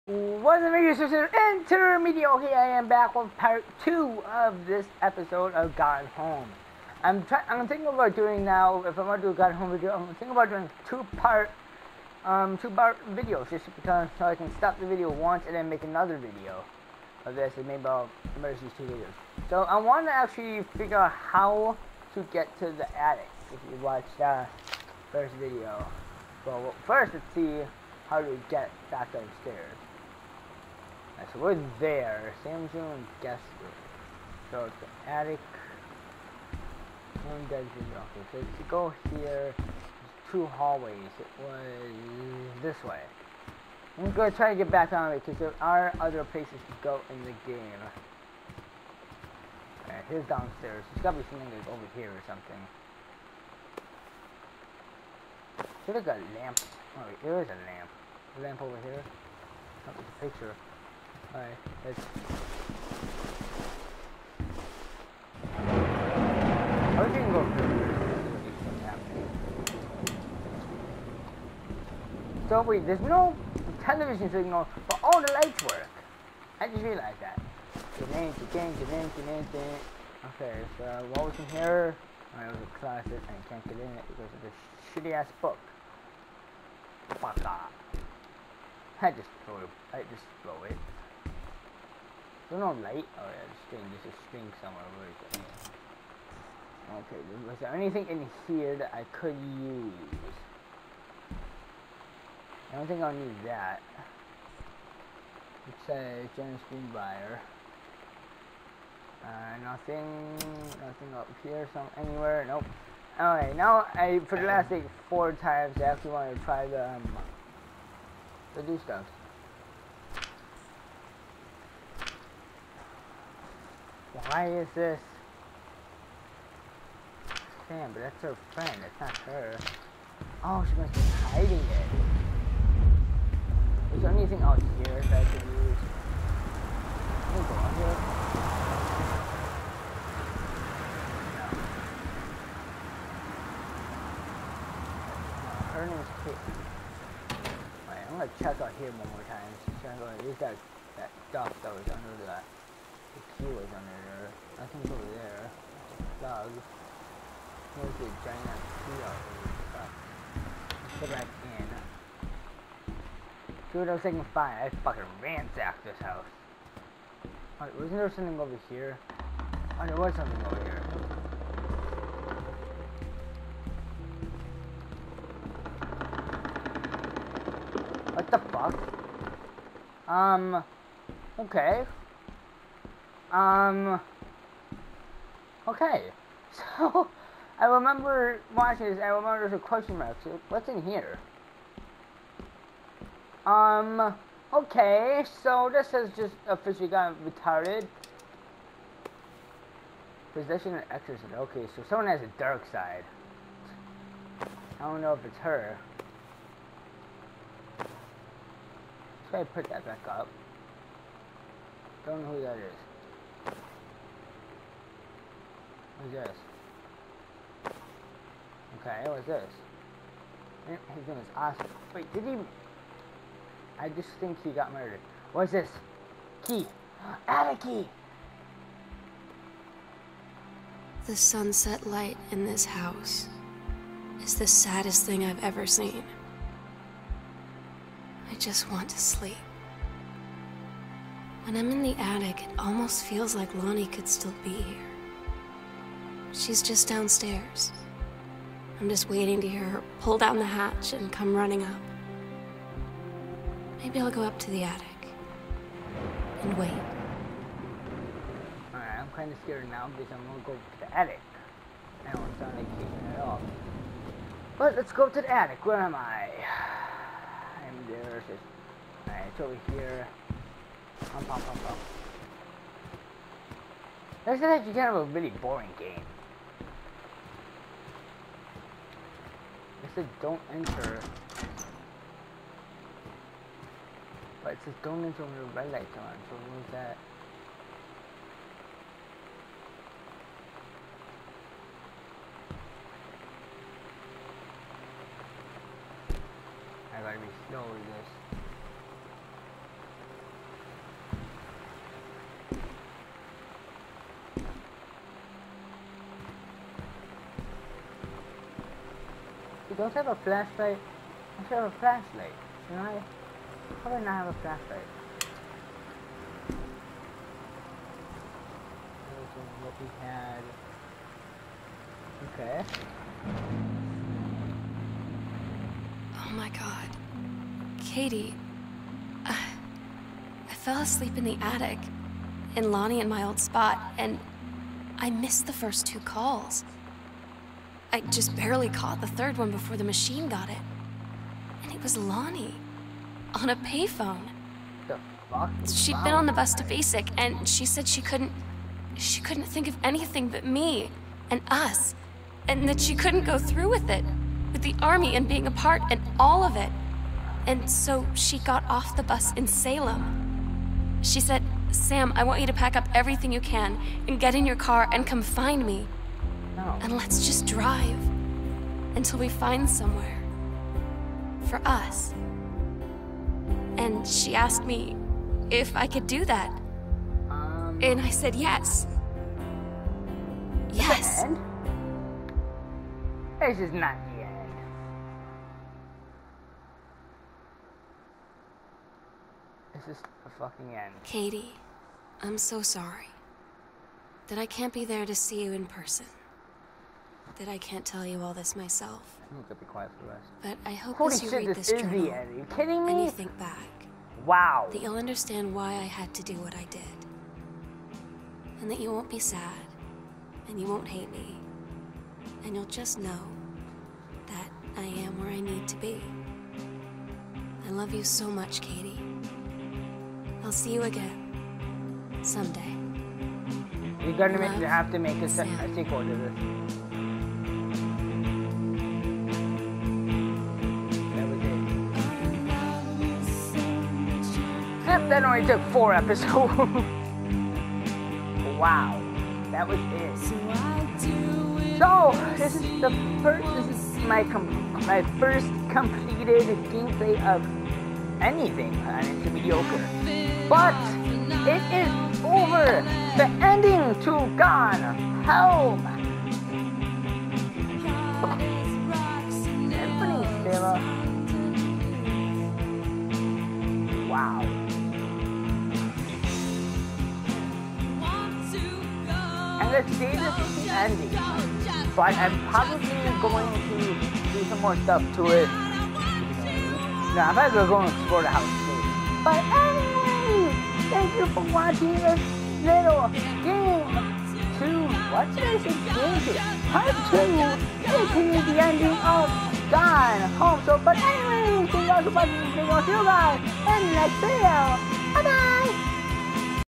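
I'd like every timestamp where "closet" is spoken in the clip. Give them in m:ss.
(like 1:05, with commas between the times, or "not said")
1:22.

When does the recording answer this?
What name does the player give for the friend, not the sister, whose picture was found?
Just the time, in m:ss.
2:25.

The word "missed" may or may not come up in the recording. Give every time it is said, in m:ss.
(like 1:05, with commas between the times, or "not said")
5:35.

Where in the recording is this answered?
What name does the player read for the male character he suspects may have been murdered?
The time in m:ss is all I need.
3:41.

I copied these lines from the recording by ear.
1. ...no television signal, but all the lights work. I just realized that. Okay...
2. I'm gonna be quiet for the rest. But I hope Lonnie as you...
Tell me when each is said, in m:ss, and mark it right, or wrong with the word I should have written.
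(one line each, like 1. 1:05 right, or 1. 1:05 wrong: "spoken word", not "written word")
1. 1:12 right
2. 6:39 wrong: "Holy", not "Lonnie".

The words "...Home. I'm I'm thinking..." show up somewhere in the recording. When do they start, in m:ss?
0:06.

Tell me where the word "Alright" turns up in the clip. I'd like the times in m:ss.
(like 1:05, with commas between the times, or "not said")
0:49, 1:01, 1:53, 2:47, 4:18.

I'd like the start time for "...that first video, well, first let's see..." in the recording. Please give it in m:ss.
0:24.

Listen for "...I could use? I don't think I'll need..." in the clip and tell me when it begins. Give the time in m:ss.
1:38.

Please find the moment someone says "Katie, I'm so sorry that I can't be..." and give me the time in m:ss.
6:31.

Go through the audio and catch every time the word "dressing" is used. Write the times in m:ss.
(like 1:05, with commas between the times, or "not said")
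not said.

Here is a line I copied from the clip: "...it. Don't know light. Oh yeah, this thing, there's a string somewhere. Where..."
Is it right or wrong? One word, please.
right.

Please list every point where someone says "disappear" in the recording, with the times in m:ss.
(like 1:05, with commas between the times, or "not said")
not said.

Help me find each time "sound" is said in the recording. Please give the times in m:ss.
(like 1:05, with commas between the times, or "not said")
4:22.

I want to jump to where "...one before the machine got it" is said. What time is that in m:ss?
5:39.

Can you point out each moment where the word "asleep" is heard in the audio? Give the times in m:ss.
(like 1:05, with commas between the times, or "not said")
5:30.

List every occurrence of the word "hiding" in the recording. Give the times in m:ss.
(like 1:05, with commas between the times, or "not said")
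2:11.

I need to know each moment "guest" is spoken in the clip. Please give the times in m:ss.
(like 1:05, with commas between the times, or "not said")
0:33.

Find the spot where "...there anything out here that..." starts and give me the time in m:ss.
2:14.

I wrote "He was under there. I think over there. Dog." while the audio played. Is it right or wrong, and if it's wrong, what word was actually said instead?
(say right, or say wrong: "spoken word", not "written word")
right.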